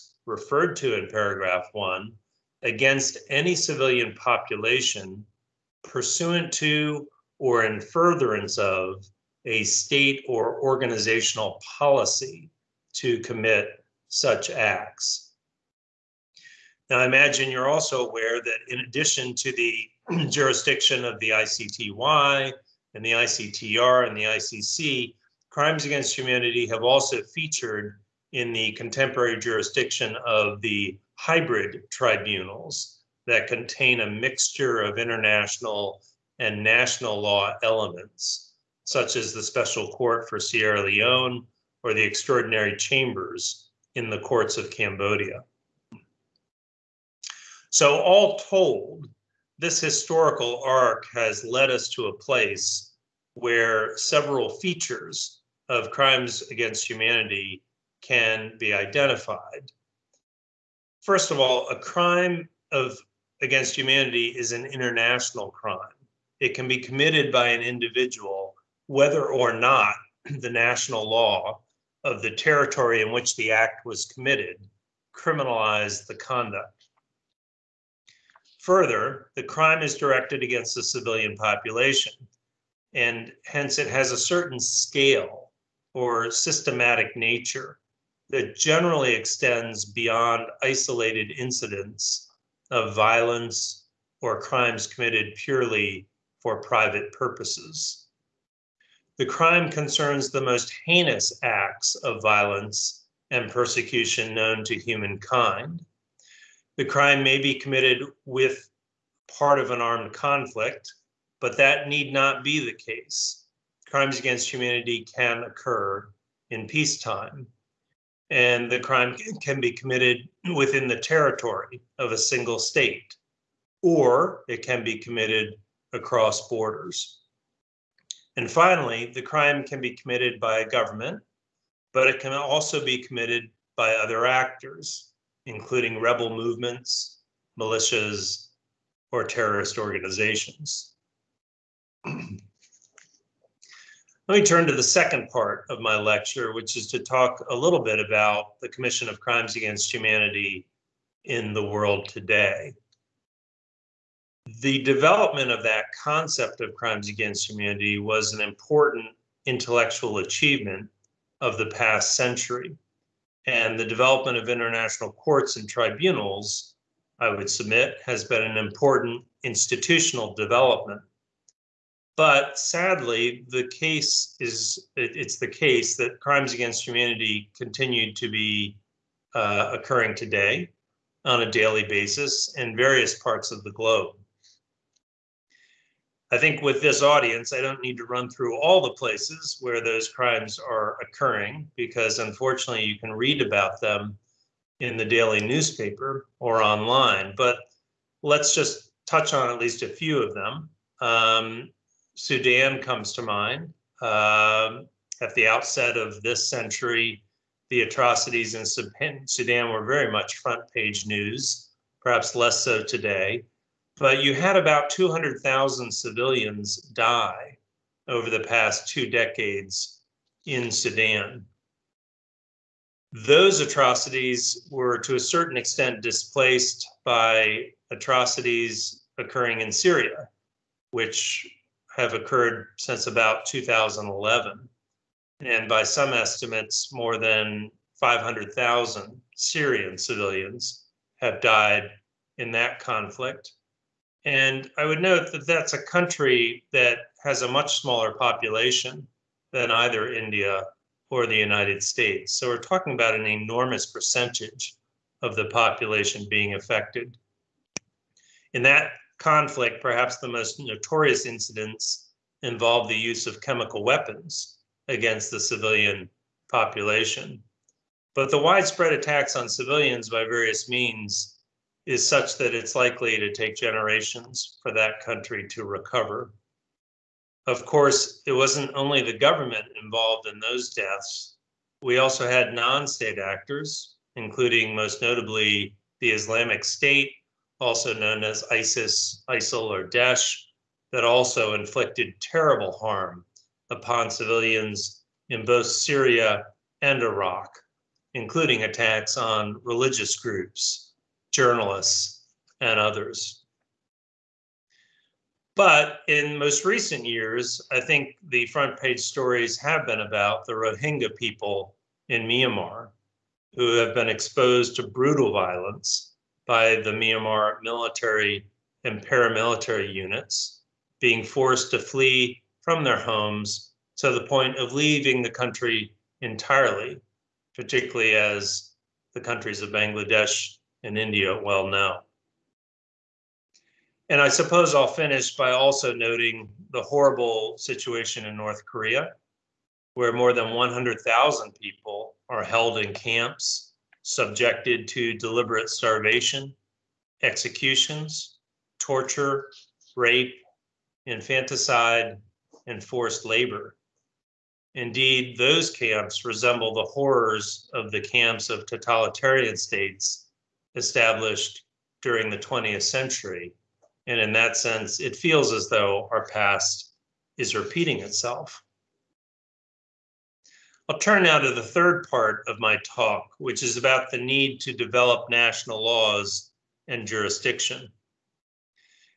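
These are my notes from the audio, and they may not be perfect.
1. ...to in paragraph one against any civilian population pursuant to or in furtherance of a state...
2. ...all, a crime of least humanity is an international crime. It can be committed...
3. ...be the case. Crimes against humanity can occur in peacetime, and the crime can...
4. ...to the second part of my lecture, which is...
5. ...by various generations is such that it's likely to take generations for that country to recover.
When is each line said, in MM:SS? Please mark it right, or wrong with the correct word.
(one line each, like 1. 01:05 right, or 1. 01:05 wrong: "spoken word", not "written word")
1. 00:00 right
2. 01:01 wrong: "against", not "least"
3. 01:52 right
4. 02:24 right
5. 04:30 wrong: "means", not "generations".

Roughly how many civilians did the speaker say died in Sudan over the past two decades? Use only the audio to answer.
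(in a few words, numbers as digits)
200,000.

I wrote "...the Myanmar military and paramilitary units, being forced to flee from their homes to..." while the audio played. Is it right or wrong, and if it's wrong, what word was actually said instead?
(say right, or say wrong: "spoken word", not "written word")
right.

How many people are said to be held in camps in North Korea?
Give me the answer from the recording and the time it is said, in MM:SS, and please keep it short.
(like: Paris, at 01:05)
more than 100,000, at 05:40.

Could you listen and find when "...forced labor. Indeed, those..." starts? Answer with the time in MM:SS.
05:52.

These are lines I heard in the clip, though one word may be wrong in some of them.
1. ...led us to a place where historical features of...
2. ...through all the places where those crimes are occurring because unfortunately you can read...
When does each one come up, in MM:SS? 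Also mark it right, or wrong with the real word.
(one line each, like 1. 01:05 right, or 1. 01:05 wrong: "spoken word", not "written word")
1. 00:51 wrong: "several", not "historical"
2. 03:08 right.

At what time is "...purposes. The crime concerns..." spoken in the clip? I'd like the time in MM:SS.
01:37.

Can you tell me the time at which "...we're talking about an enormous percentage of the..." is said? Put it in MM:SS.
04:12.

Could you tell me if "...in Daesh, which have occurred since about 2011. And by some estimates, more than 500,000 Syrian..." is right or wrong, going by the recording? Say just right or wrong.
wrong.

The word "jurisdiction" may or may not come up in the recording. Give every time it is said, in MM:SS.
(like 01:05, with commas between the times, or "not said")
00:20, 00:29, 06:17.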